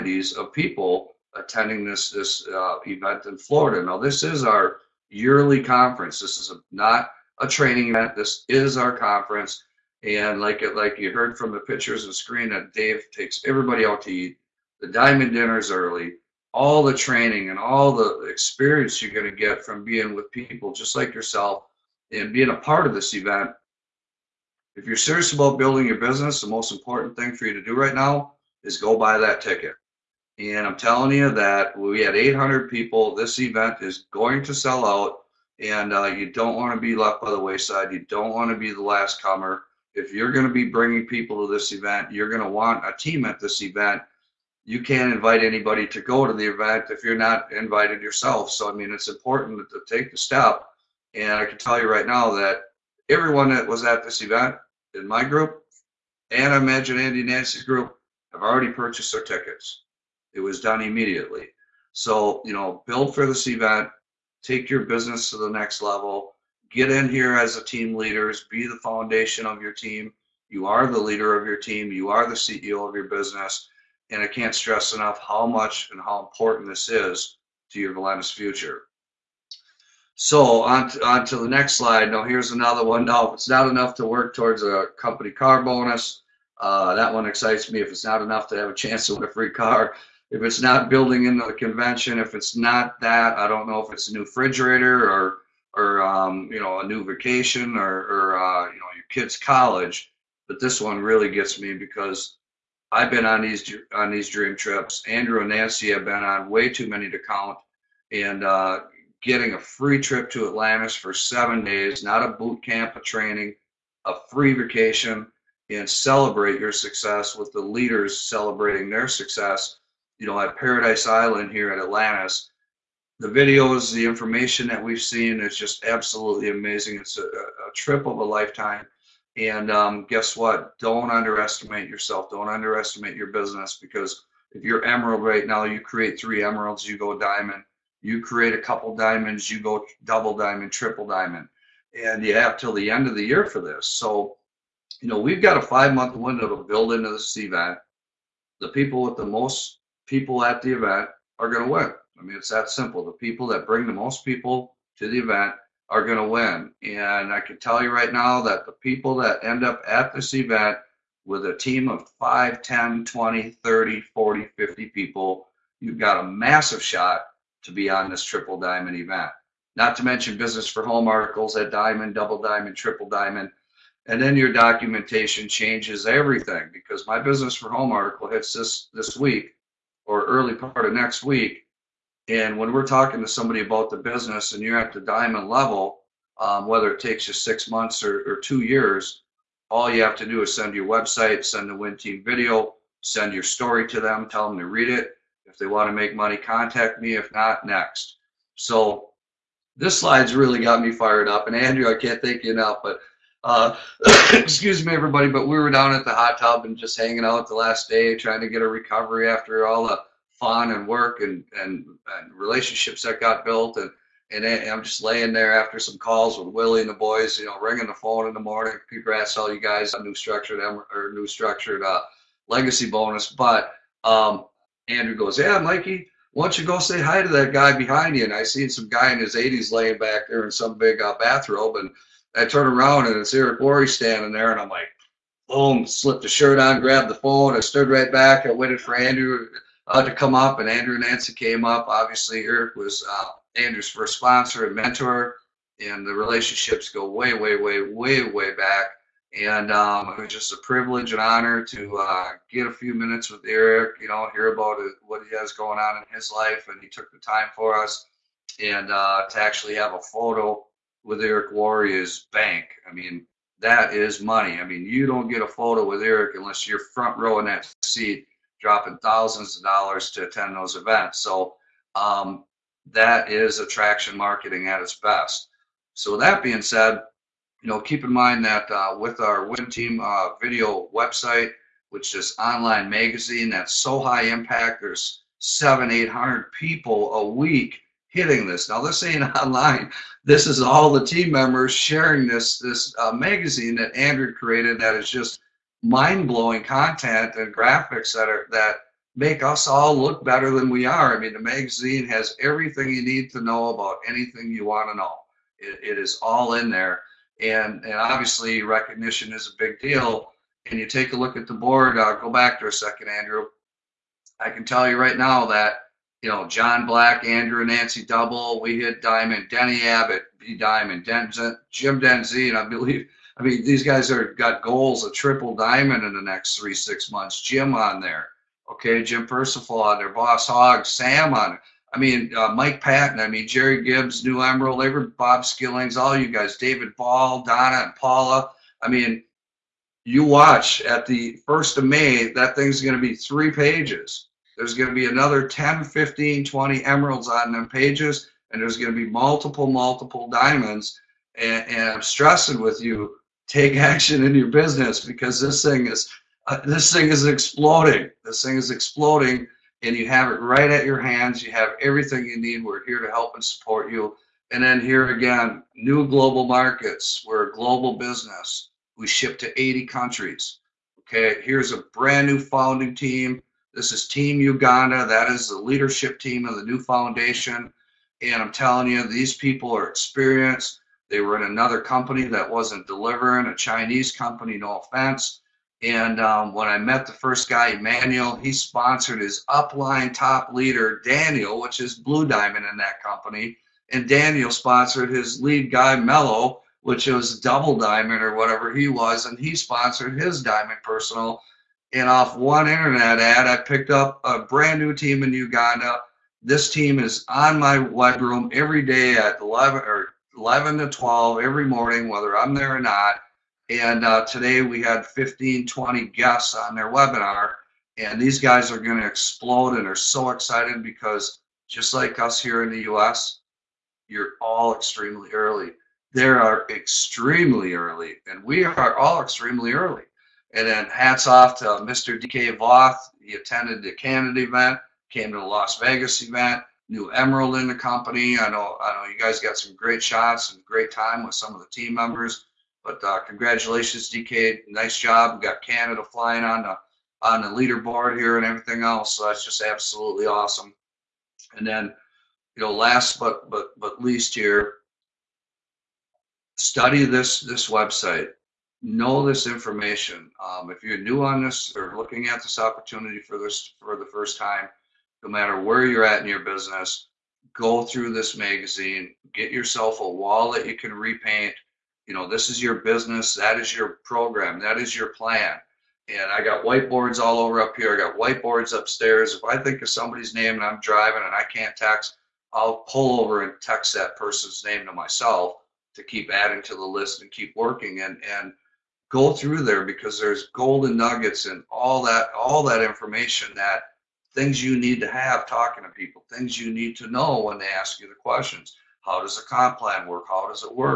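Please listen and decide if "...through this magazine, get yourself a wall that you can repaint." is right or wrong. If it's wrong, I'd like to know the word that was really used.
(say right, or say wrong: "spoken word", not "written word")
right.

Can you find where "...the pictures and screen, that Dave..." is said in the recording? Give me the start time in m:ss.
0:11.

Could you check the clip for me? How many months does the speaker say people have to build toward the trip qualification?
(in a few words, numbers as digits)
5.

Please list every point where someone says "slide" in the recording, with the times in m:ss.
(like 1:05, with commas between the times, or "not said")
1:21, 3:19.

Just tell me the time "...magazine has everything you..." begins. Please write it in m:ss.
5:01.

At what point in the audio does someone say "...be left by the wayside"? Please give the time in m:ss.
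0:36.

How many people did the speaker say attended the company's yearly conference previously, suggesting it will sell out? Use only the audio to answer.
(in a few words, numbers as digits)
800.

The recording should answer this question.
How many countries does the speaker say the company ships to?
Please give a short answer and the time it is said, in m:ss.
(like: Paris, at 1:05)
80, at 6:09.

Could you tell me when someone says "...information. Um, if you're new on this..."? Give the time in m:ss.
7:39.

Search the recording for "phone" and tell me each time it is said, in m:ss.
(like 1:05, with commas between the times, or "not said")
3:37, 3:57.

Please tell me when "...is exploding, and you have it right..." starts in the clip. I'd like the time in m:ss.
5:58.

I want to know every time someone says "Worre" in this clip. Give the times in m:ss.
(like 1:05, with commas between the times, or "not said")
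3:53, 4:21.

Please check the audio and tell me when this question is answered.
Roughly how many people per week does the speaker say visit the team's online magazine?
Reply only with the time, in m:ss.
4:45.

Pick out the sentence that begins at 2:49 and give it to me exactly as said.
Not to mention business for home articles at diamond, double diamond, triple diamond.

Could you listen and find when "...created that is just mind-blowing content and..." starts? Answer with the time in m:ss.
4:54.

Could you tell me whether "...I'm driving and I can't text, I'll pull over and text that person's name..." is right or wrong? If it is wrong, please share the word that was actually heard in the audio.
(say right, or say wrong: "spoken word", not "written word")
right.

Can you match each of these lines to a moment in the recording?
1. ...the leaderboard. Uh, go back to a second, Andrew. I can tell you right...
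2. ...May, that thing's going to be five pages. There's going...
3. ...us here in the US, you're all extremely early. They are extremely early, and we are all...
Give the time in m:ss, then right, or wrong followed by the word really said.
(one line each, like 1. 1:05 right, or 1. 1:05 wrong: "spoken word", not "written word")
1. 5:11 wrong: "board", not "leaderboard"
2. 5:41 wrong: "three", not "five"
3. 7:02 right.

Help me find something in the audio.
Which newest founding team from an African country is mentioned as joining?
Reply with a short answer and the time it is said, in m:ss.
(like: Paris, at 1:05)
Team Uganda, at 6:14.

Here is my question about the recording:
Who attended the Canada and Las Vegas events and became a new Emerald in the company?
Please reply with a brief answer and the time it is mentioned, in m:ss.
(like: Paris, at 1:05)
DK Voth, at 7:12.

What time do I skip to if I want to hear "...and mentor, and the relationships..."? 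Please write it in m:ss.
4:04.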